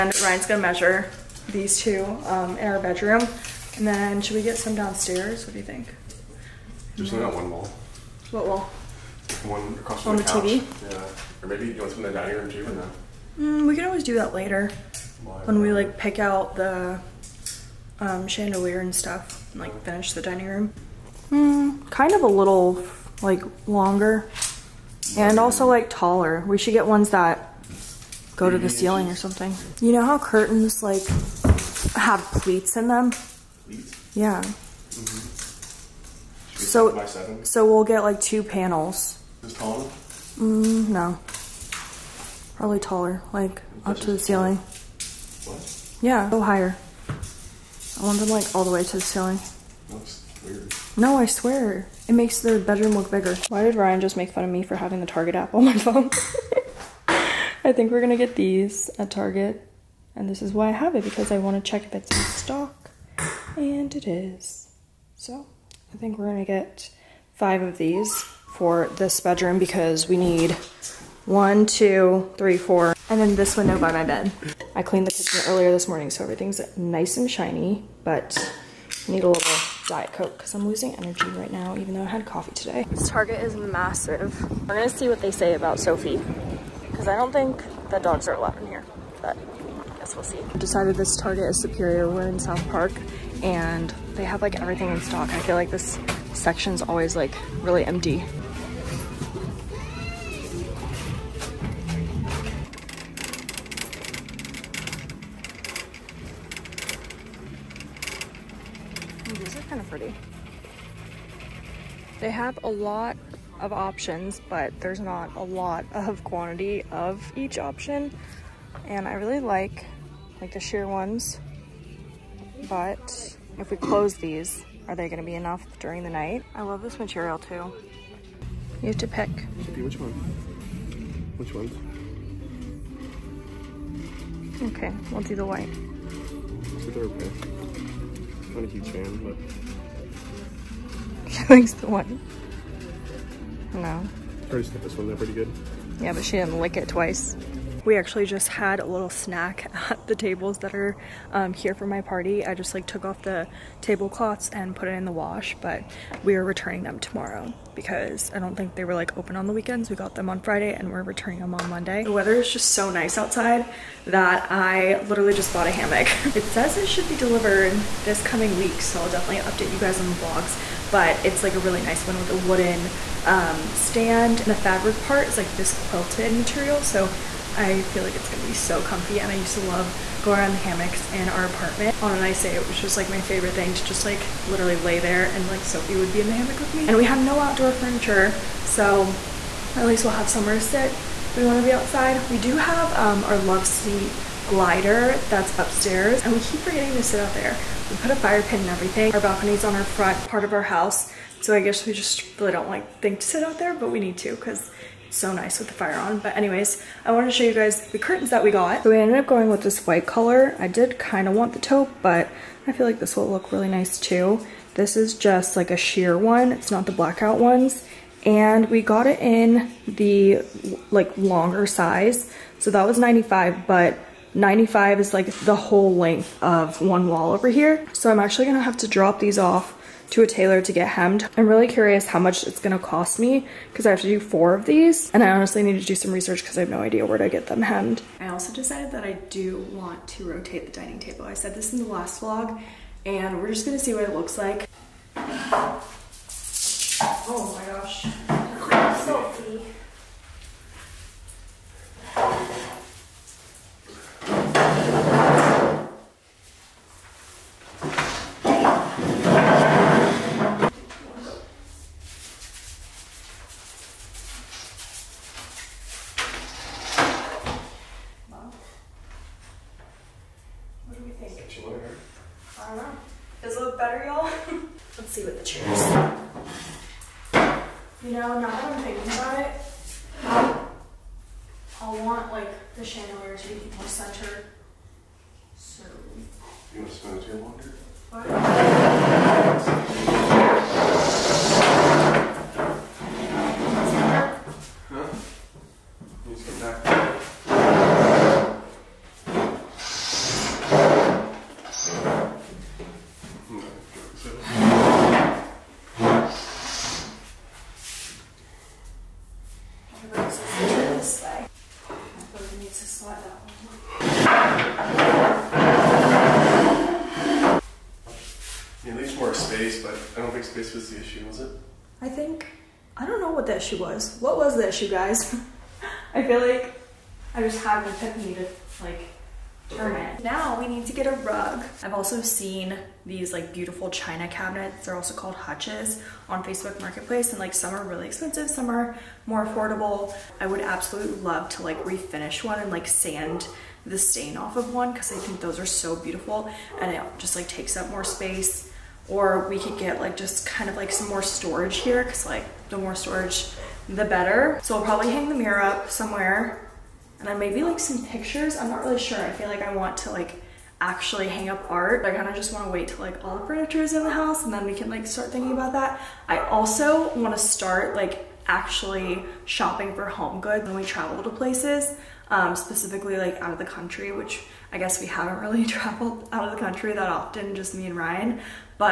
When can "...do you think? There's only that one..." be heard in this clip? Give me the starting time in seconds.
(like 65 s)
5 s.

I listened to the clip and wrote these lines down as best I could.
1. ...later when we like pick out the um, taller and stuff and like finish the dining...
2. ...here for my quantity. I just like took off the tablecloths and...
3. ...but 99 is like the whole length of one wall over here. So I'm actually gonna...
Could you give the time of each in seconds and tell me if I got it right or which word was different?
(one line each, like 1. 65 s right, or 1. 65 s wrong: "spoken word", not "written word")
1. 14 s wrong: "chandelier", not "taller"
2. 151 s wrong: "party", not "quantity"
3. 223 s wrong: "95", not "99".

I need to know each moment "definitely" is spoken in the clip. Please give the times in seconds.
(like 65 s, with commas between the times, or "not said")
169 s.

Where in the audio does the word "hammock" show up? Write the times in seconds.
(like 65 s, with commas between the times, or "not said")
165 s, 180 s, 186 s.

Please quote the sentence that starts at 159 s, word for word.
We got them on Friday and we're returning them on Monday.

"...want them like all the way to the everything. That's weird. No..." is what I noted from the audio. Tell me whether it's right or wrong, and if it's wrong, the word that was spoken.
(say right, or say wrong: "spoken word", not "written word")
wrong: "ceiling", not "everything".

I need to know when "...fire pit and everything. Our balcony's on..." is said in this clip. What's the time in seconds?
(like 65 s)
198 s.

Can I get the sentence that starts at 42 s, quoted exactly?
Probably taller, like up to the ceiling.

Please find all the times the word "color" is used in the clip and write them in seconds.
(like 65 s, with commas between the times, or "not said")
210 s.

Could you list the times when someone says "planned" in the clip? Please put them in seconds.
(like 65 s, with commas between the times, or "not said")
not said.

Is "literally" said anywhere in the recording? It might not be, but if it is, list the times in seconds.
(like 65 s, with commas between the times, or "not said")
165 s, 184 s.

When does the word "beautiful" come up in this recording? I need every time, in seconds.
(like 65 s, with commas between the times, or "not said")
333 s, 345 s.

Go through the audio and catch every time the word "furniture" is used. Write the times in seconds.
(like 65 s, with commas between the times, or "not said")
187 s, 363 s.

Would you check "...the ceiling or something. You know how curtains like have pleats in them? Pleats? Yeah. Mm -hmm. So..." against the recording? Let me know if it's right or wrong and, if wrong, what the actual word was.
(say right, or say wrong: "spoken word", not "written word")
right.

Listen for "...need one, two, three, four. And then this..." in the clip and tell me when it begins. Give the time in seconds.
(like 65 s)
70 s.